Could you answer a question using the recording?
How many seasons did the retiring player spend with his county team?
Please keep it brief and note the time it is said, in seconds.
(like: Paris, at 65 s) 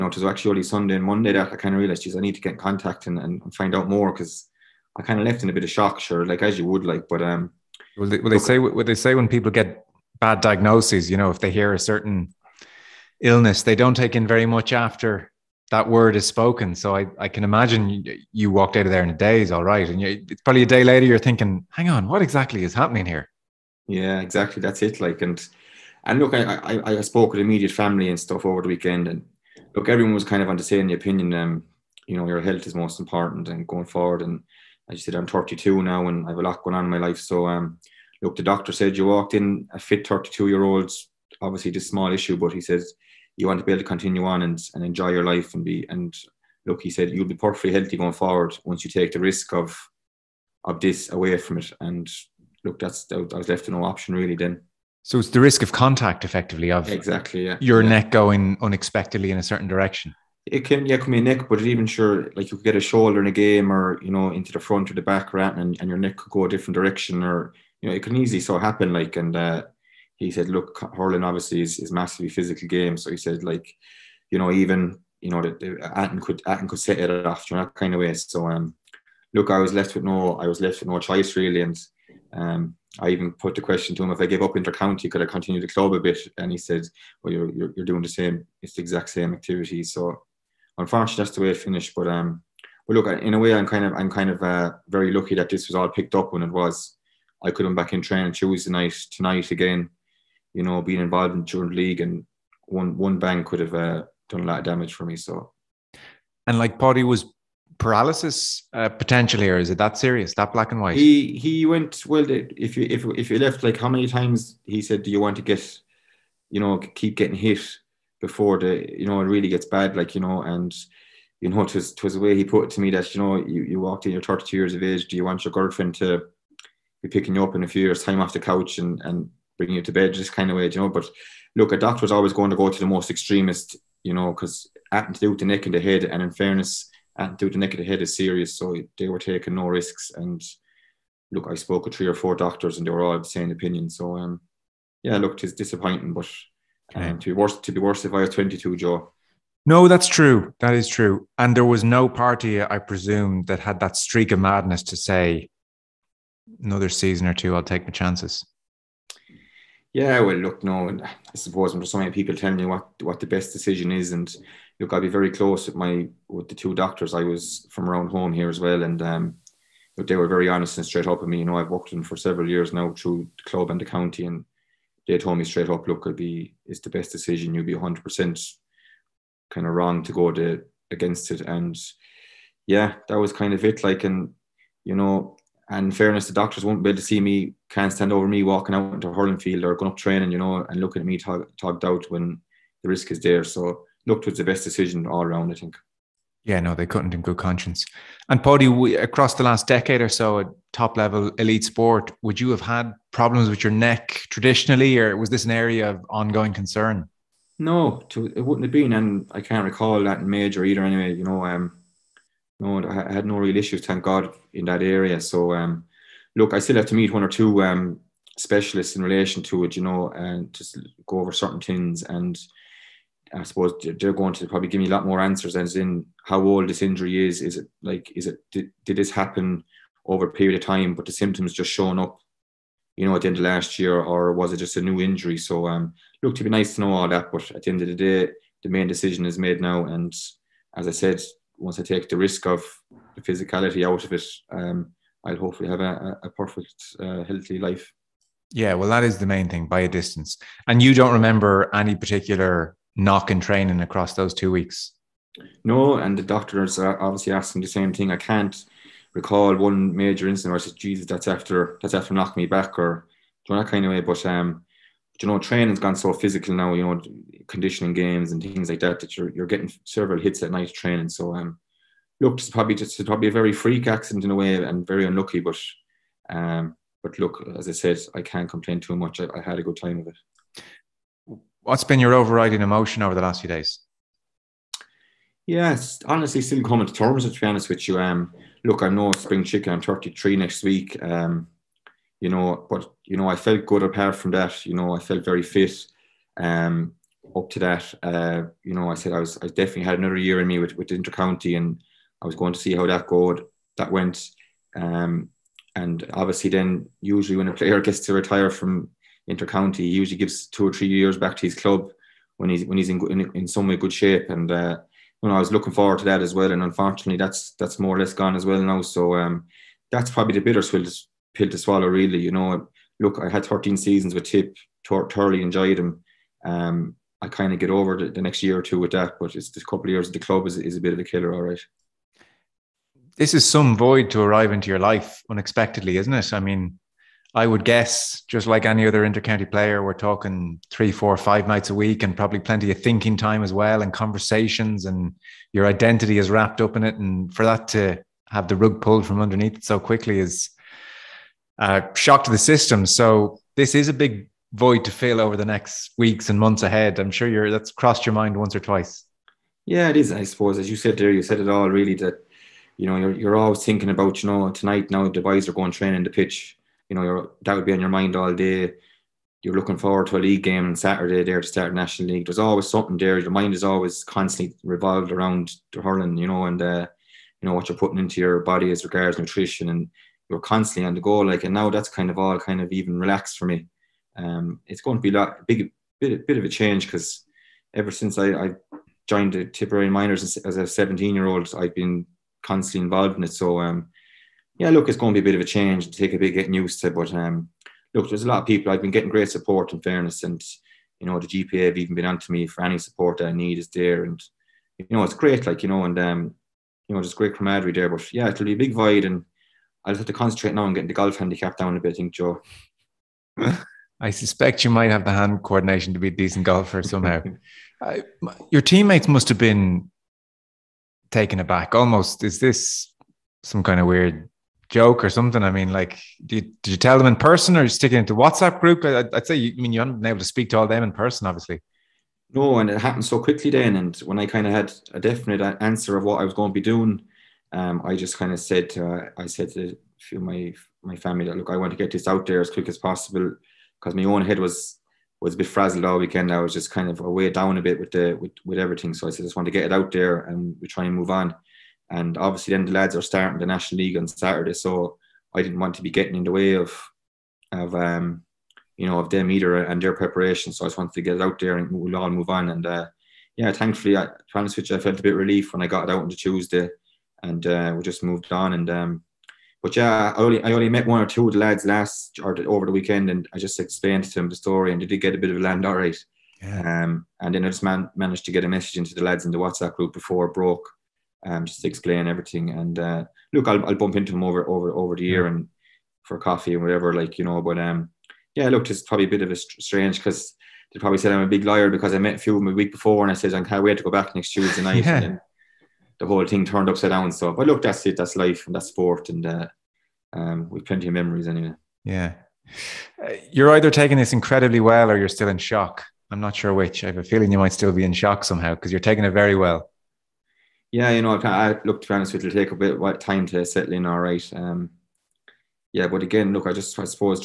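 13, at 323 s.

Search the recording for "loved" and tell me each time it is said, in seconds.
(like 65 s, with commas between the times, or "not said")
not said.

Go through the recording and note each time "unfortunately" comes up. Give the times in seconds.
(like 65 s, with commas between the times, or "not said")
90 s, 316 s.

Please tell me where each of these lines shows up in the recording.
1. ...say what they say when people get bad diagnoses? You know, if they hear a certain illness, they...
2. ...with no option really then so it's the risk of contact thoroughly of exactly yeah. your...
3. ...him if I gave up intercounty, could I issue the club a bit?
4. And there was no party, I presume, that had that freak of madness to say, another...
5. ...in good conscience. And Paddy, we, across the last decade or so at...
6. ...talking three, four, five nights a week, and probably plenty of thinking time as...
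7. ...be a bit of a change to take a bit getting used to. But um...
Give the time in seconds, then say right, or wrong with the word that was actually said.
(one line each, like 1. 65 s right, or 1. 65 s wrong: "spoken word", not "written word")
1. 8 s right
2. 53 s wrong: "effectively", not "thoroughly"
3. 84 s wrong: "continue", not "issue"
4. 151 s wrong: "streak", not "freak"
5. 197 s right
6. 339 s right
7. 395 s right.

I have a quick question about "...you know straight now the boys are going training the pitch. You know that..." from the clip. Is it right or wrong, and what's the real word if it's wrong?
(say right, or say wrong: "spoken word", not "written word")
wrong: "tonight", not "straight".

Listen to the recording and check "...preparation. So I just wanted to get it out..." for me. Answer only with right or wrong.
right.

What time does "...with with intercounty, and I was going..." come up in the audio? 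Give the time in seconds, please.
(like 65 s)
300 s.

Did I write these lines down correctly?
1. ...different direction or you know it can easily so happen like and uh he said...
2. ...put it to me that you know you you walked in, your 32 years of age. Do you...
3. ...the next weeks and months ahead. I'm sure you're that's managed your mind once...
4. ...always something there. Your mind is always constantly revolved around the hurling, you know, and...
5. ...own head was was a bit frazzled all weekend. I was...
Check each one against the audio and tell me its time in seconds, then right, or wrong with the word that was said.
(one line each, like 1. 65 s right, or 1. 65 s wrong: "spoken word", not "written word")
1. 66 s right
2. 122 s right
3. 355 s wrong: "crossed", not "managed"
4. 372 s right
5. 444 s right.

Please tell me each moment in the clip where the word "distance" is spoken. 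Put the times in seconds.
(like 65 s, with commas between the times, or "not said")
249 s.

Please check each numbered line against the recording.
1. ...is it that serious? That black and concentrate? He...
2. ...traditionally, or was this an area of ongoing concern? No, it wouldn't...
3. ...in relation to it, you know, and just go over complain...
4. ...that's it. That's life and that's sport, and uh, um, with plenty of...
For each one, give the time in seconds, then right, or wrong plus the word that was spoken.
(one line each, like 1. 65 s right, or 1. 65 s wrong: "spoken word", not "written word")
1. 109 s wrong: "white", not "concentrate"
2. 204 s right
3. 218 s wrong: "certain", not "complain"
4. 497 s right.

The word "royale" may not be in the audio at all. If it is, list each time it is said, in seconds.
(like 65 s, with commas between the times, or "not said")
not said.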